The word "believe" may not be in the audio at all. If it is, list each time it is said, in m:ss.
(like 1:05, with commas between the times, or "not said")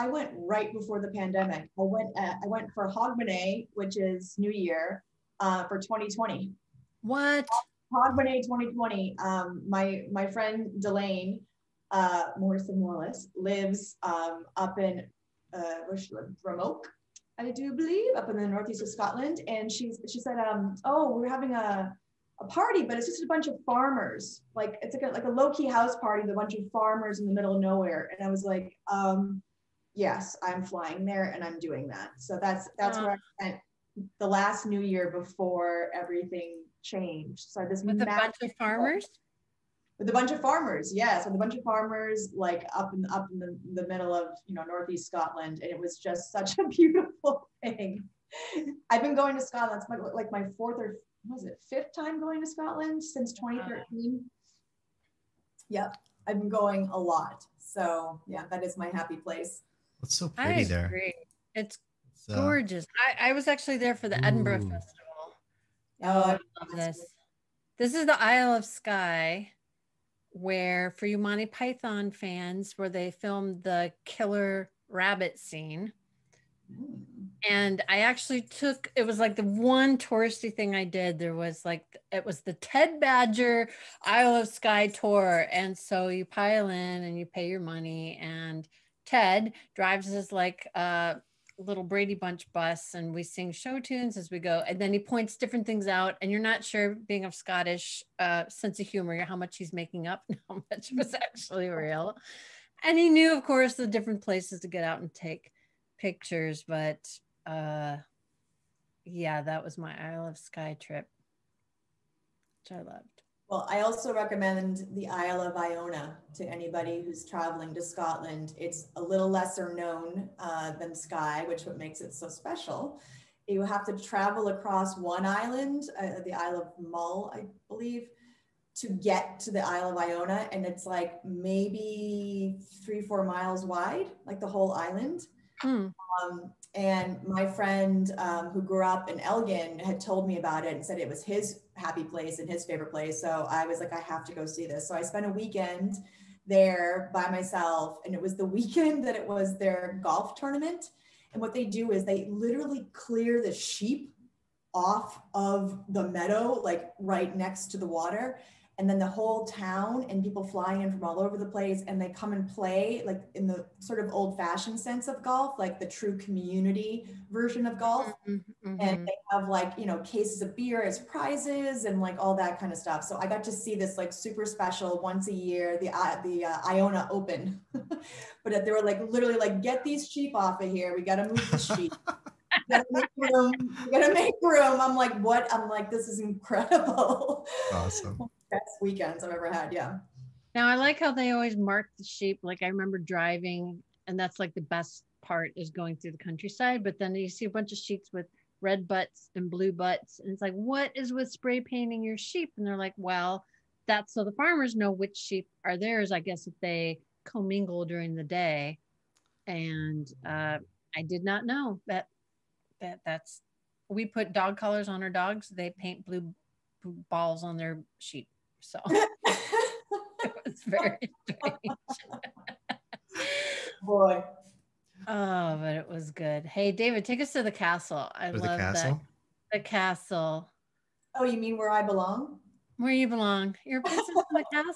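0:17, 2:07.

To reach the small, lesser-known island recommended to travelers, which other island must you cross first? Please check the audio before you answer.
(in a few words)
Isle of Mull.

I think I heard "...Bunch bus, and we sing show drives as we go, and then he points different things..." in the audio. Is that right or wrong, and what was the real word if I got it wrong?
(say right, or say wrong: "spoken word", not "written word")
wrong: "tunes", not "drives".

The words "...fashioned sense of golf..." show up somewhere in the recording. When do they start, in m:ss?
2:44.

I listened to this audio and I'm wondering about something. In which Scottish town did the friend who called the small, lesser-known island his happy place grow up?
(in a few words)
Elgin.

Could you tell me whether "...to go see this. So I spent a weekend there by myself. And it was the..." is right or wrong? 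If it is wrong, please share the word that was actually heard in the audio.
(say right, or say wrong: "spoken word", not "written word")
right.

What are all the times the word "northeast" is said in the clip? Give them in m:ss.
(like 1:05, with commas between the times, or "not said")
0:18, 0:44.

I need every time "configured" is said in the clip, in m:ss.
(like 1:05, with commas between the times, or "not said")
not said.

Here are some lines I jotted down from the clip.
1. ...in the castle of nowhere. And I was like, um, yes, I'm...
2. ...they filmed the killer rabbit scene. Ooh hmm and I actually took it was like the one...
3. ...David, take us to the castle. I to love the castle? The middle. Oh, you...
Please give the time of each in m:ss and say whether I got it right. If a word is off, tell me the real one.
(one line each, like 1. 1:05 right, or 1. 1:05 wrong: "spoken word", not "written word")
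1. 0:27 wrong: "middle", not "castle"
2. 1:12 right
3. 3:46 wrong: "castle", not "middle".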